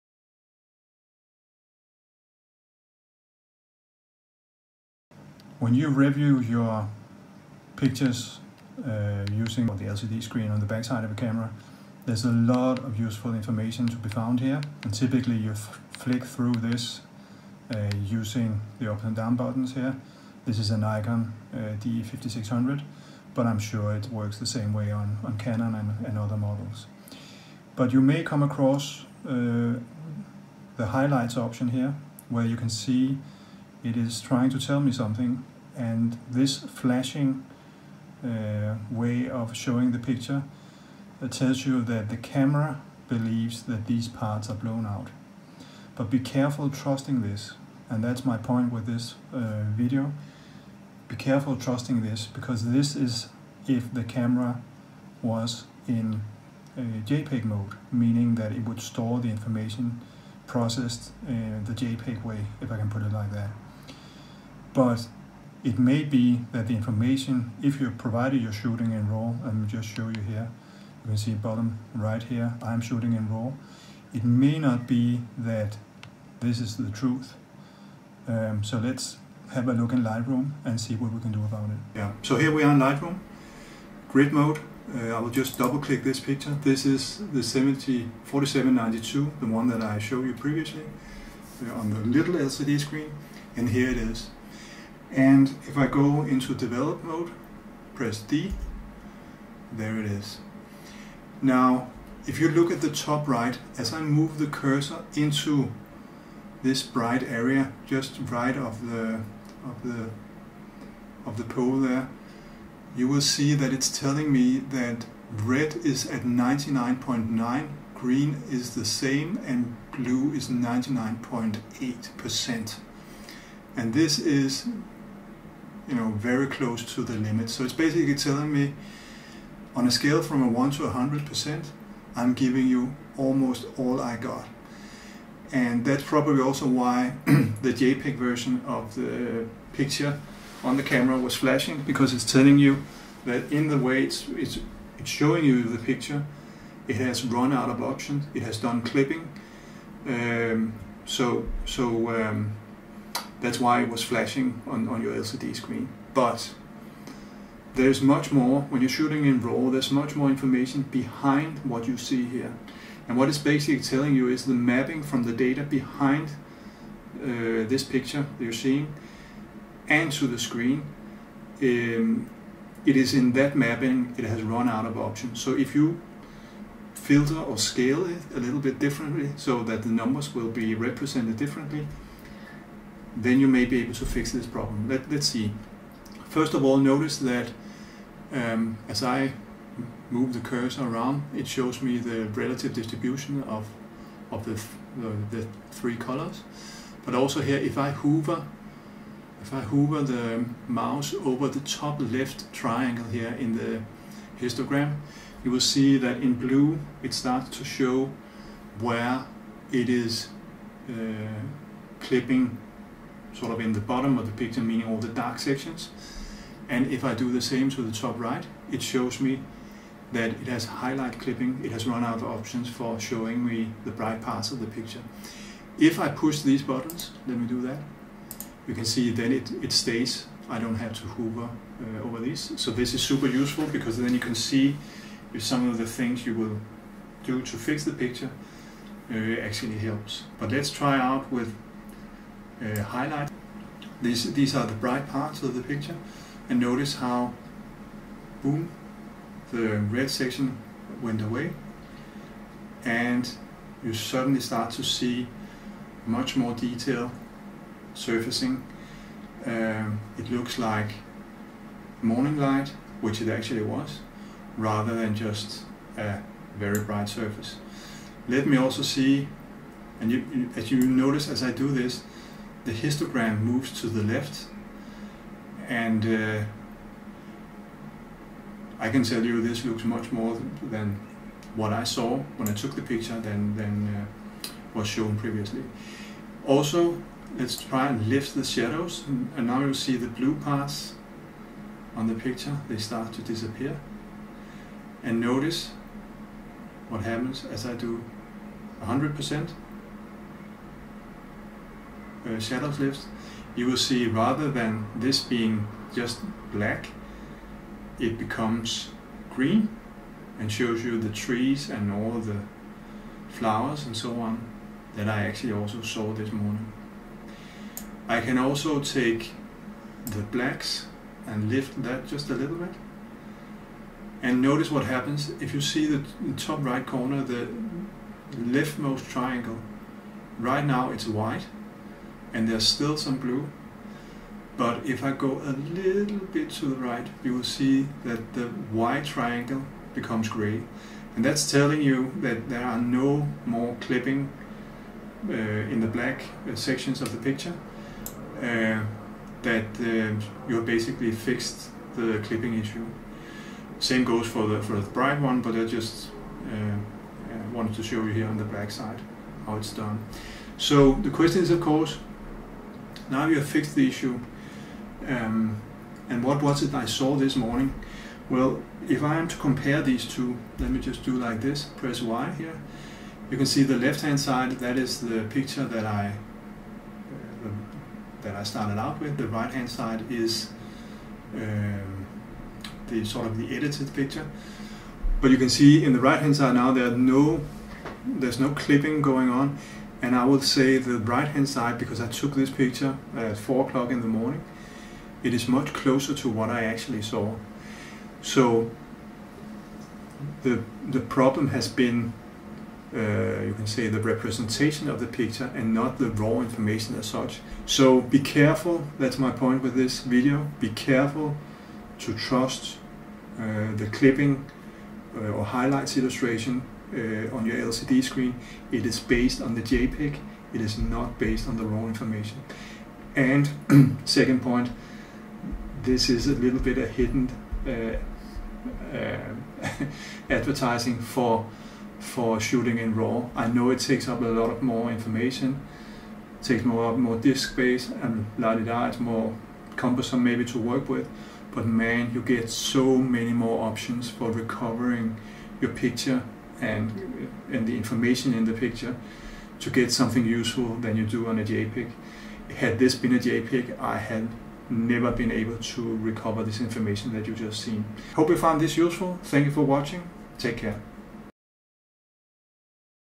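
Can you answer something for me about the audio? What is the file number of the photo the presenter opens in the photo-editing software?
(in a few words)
704792.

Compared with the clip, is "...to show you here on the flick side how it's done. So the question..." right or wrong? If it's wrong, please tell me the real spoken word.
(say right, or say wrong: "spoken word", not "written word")
wrong: "black", not "flick".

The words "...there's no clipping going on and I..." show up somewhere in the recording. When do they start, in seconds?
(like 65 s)
388 s.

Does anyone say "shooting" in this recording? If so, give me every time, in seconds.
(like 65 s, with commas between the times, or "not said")
68 s, 72 s, 158 s, 432 s.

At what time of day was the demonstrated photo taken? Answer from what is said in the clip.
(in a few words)
4 o'clock in the morning.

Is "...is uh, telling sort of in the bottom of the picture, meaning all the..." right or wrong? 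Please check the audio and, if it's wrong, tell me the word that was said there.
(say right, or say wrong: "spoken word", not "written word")
wrong: "clipping", not "telling".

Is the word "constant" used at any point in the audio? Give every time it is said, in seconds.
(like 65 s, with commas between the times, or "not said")
not said.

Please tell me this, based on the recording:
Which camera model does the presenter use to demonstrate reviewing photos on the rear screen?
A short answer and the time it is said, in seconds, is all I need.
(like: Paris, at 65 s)
Nikon D5600, at 20 s.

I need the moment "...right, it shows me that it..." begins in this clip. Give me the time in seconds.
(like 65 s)
218 s.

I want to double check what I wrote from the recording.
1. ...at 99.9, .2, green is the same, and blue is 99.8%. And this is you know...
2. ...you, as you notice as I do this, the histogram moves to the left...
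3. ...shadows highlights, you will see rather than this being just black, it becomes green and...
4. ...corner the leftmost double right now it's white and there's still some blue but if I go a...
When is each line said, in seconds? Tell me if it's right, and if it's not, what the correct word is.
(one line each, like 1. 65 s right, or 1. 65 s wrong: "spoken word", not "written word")
1. 116 s wrong: "9", not "2"
2. 270 s right
3. 302 s wrong: "lifts", not "highlights"
4. 326 s wrong: "triangle", not "double".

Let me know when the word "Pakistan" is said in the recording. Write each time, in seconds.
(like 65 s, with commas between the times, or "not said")
not said.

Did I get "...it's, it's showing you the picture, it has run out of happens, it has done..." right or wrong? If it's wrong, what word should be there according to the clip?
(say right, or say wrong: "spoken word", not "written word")
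wrong: "options", not "happens".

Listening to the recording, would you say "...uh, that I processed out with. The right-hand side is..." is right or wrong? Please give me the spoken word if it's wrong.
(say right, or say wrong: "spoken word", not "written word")
wrong: "started", not "processed".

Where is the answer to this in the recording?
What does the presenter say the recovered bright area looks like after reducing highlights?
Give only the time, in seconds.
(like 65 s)
262 s.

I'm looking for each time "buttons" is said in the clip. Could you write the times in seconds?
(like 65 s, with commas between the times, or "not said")
19 s, 226 s.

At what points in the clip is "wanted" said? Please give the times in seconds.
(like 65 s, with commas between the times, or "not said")
357 s.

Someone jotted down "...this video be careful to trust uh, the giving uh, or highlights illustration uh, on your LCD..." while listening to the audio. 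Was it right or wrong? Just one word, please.
wrong.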